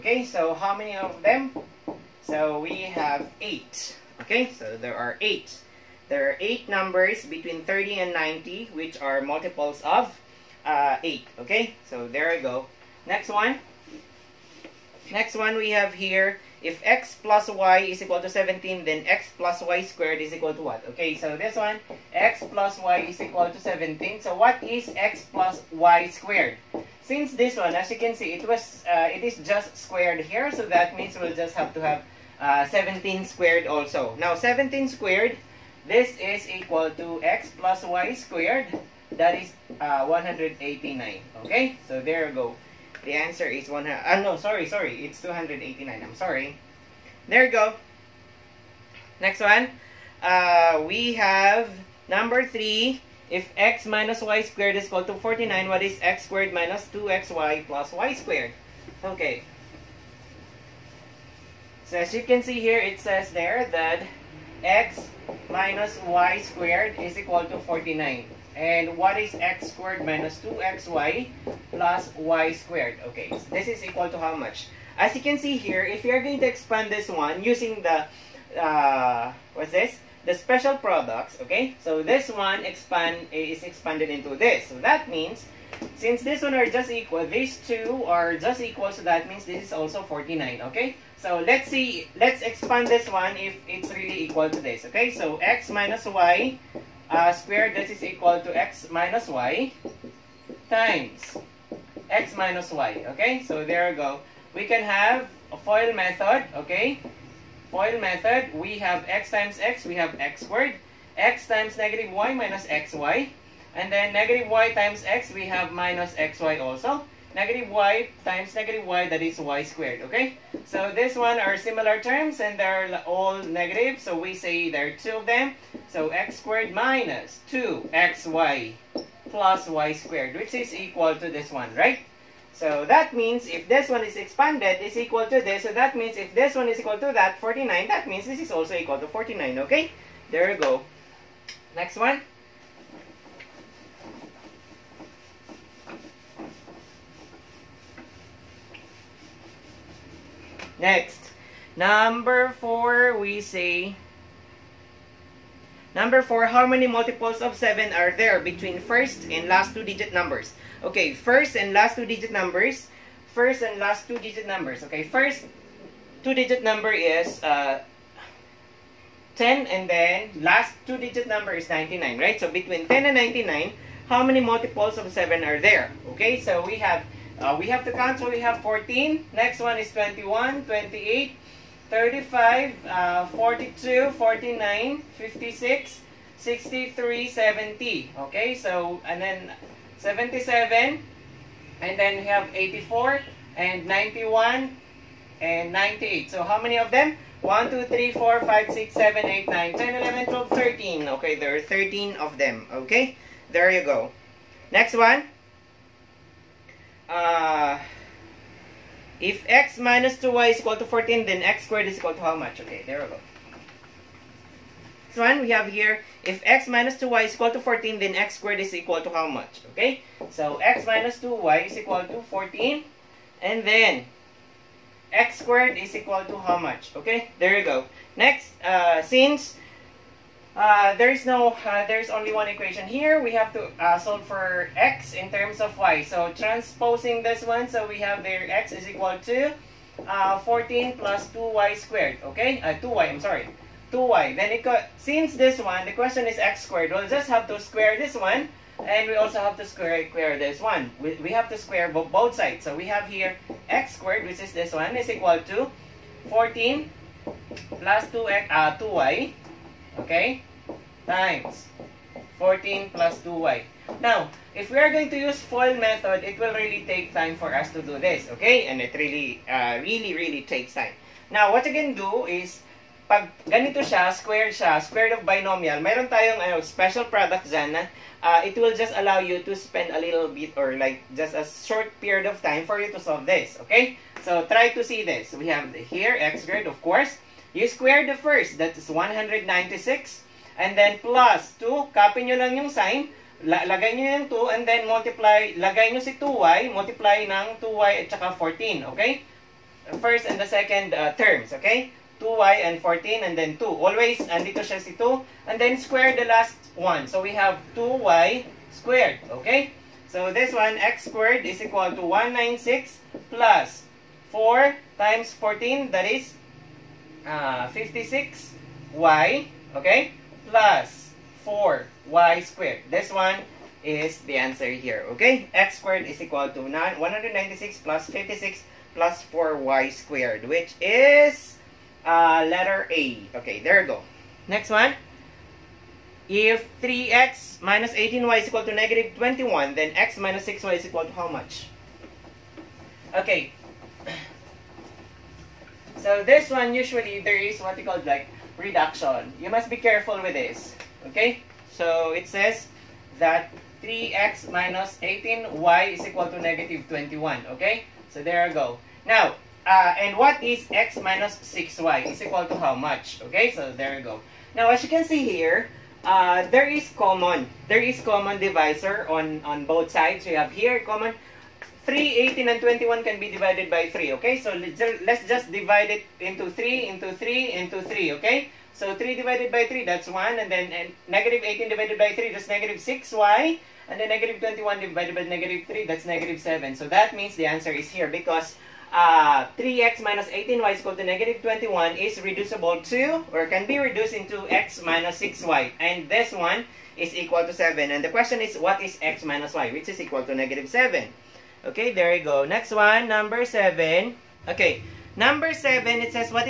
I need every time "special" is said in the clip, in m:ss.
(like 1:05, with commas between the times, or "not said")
1:20, 4:36.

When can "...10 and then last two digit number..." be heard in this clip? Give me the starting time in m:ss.
2:49.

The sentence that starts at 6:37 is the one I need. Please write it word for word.
And the question is, what is x minus y?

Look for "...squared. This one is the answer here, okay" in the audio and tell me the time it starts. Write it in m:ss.
5:22.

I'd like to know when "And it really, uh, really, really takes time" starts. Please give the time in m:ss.
4:28.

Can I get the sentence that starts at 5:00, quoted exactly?
First and the second uh, terms, okay?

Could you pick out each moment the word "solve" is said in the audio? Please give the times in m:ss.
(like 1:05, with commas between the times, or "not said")
3:53, 4:42.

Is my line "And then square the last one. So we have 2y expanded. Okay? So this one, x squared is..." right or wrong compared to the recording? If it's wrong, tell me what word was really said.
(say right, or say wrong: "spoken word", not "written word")
wrong: "squared", not "expanded".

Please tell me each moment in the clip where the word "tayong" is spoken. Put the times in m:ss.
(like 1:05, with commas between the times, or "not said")
4:36.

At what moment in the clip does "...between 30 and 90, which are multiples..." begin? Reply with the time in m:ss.
0:07.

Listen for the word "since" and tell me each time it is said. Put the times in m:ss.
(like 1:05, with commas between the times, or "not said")
0:27, 1:25, 3:49, 4:04.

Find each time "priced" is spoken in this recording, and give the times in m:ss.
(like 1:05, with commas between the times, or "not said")
not said.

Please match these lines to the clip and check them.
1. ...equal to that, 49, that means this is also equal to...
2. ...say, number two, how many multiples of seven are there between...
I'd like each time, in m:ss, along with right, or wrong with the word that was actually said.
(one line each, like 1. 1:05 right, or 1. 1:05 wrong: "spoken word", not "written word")
1. 2:16 right
2. 2:33 wrong: "four", not "two".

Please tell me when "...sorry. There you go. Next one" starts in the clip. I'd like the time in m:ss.
0:46.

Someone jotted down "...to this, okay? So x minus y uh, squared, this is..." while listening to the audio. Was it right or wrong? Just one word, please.
right.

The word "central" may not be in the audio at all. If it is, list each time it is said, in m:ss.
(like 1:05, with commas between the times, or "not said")
not said.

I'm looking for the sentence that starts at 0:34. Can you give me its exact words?
Now, 17 squared, this is equal to x plus y squared.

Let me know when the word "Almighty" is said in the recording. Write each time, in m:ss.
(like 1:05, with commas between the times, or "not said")
not said.